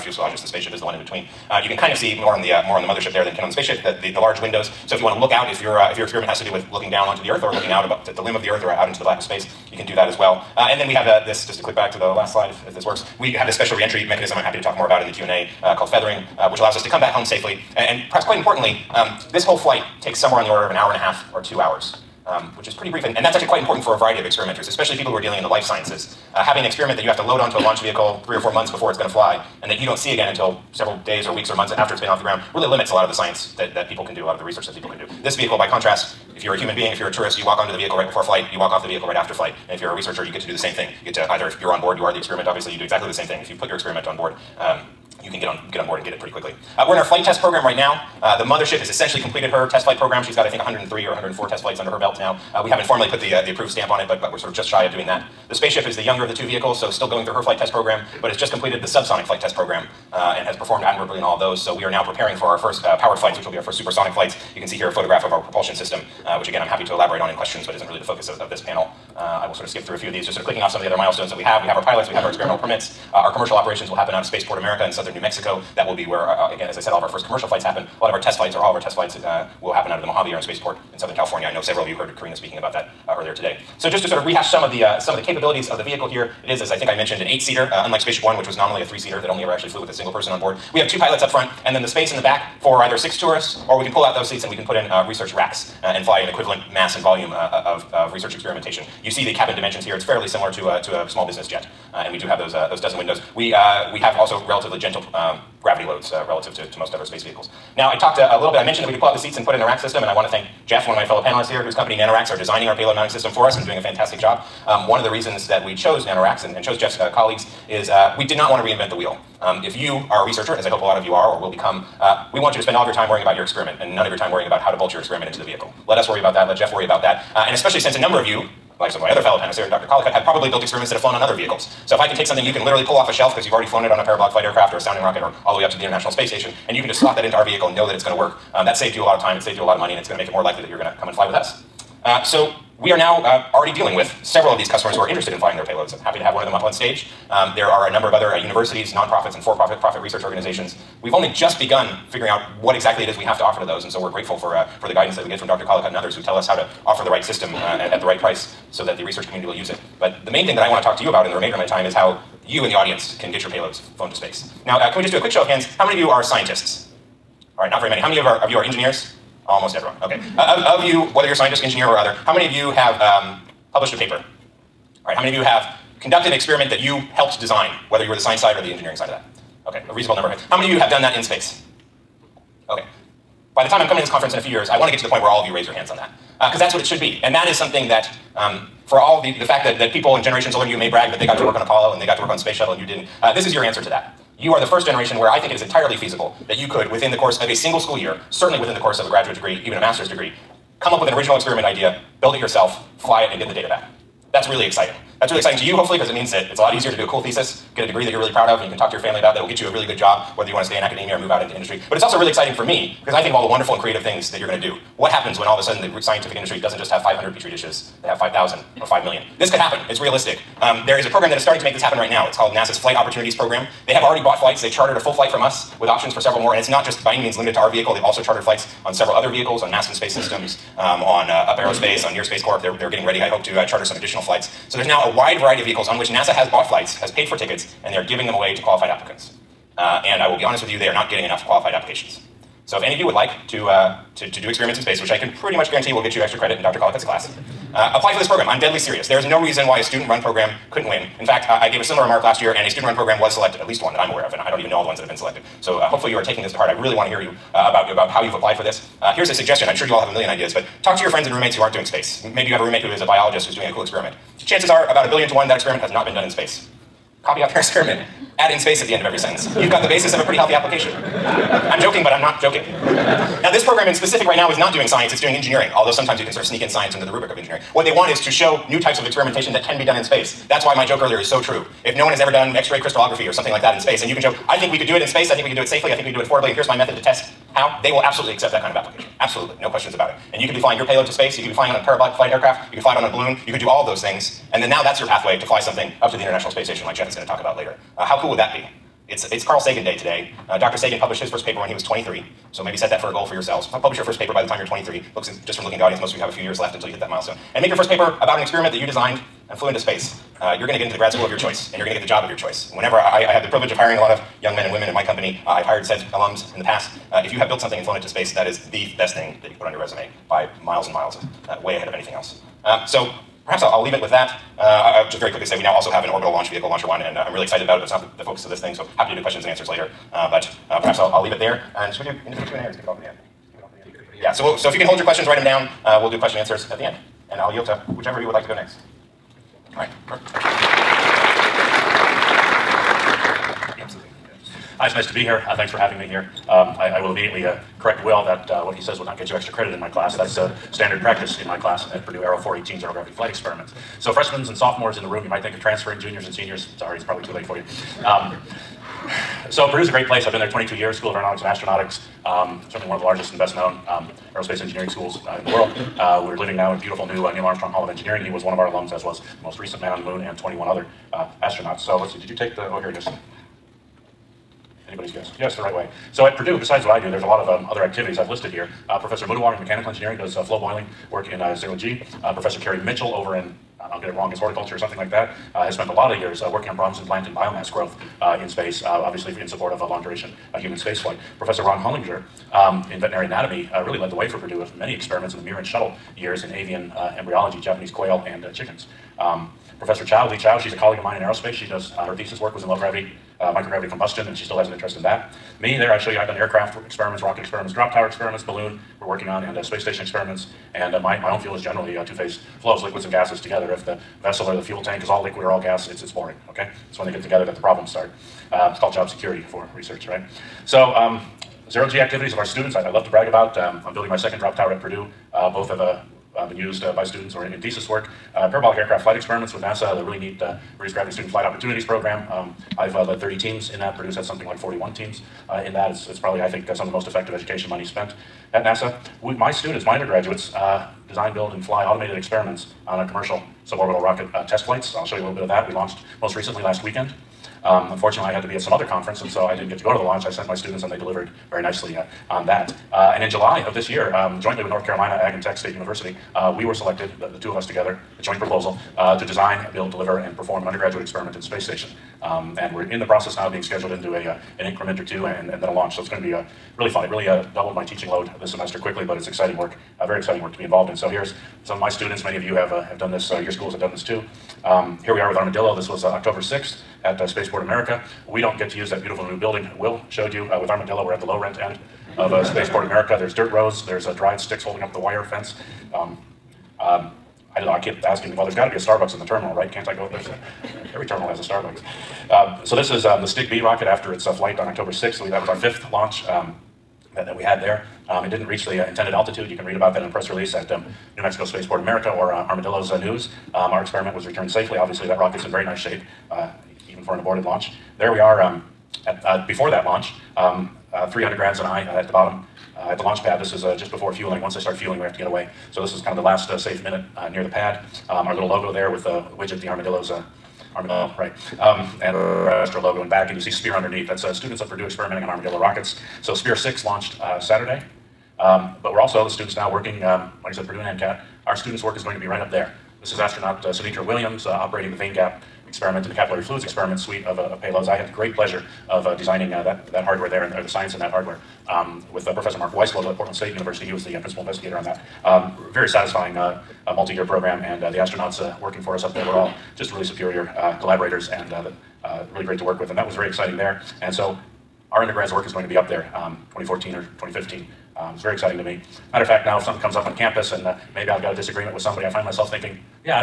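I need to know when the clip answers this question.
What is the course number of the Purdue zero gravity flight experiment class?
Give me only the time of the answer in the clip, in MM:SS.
05:52.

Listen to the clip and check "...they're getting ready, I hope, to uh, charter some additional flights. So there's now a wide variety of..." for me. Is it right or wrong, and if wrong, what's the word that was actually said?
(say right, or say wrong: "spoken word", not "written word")
right.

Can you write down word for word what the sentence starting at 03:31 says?
But it's also really exciting for me because I think of all the wonderful and creative things that you're going to do.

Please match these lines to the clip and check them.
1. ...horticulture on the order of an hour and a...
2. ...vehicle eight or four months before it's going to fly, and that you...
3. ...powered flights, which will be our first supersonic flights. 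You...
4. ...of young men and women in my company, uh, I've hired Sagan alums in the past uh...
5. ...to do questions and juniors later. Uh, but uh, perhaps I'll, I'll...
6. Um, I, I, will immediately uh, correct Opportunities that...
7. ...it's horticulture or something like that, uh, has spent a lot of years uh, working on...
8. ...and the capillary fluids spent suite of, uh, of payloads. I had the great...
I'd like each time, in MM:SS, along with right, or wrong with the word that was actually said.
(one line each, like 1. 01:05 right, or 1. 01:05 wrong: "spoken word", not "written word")
1. 00:20 wrong: "somewhere", not "horticulture"
2. 00:27 wrong: "three", not "eight"
3. 01:02 right
4. 05:14 wrong: "SEDS", not "Sagan"
5. 05:29 wrong: "answers", not "juniors"
6. 05:46 wrong: "Will", not "Opportunities"
7. 06:24 right
8. 08:56 wrong: "experiment", not "spent".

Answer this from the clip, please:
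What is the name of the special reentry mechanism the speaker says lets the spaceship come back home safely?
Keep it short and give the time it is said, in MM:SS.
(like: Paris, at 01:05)
Feathering, at 00:15.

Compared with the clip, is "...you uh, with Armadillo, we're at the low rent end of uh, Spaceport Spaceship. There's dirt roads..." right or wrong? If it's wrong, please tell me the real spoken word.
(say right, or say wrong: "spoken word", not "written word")
wrong: "America", not "Spaceship".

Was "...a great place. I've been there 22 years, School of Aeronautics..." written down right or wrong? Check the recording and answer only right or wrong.
right.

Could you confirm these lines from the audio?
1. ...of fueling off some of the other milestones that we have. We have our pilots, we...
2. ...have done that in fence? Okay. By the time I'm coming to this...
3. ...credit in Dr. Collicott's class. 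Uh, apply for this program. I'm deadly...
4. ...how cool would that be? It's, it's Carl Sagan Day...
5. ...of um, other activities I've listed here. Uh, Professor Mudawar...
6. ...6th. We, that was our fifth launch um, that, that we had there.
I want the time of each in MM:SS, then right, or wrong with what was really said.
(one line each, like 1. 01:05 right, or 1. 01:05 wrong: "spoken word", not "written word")
1. 01:10 wrong: "clicking", not "fueling"
2. 03:00 wrong: "space", not "fence"
3. 04:06 right
4. 04:58 right
5. 06:17 right
6. 08:14 right.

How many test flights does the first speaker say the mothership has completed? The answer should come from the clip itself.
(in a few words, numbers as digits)
103 or 104.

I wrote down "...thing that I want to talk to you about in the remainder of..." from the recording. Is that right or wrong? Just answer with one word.
right.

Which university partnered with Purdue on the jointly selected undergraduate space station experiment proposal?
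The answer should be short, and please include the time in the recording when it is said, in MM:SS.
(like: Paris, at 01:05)
North Carolina Ag and Tech State University, at 07:34.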